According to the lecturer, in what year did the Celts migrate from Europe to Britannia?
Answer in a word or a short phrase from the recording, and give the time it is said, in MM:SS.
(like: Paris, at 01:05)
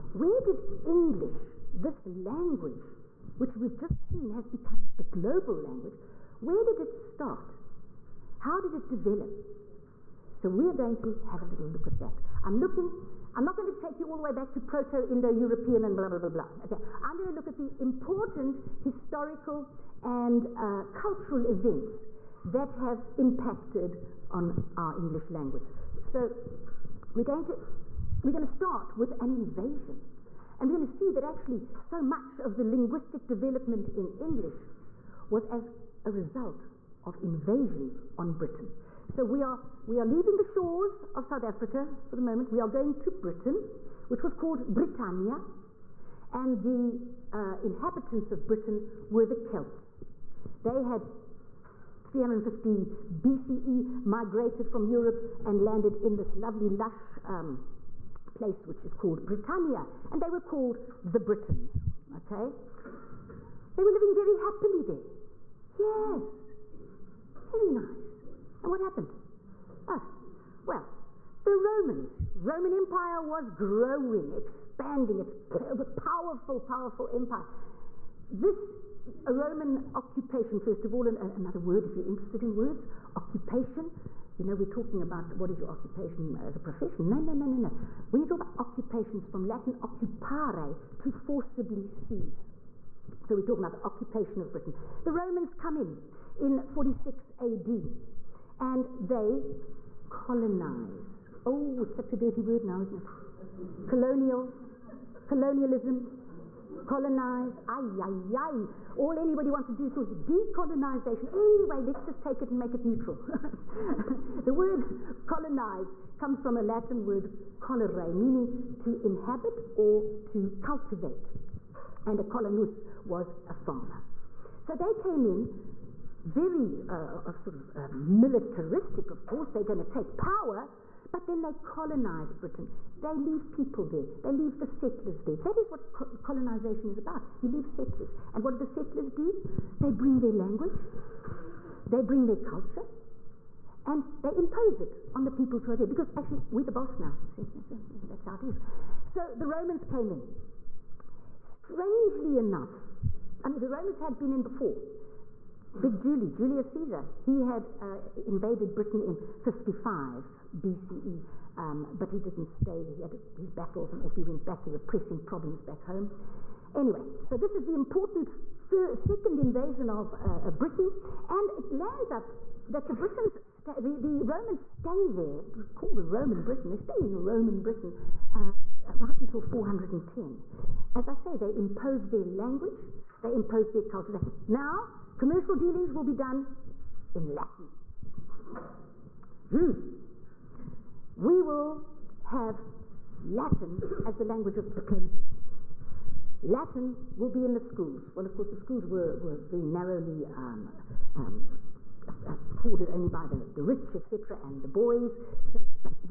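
350 BCE, at 00:52.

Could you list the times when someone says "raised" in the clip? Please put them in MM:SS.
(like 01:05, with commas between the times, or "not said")
not said.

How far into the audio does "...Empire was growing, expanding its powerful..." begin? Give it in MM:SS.
01:12.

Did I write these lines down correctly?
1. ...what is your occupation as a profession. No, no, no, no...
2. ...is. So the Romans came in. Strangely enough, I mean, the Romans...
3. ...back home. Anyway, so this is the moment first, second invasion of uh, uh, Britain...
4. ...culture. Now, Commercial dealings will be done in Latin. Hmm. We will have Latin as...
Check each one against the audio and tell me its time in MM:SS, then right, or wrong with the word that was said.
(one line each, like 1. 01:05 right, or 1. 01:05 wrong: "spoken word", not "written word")
1. 01:25 right
2. 02:28 right
3. 02:45 wrong: "important", not "moment"
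4. 03:03 right.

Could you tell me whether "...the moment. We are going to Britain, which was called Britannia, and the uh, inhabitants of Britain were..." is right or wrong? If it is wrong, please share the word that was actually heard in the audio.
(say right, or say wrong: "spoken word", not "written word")
right.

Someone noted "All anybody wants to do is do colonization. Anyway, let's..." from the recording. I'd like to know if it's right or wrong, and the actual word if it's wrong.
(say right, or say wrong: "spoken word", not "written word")
wrong: "decolonization", not "colonization".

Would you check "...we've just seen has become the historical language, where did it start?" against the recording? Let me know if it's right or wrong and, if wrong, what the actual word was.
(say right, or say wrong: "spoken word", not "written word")
wrong: "global", not "historical".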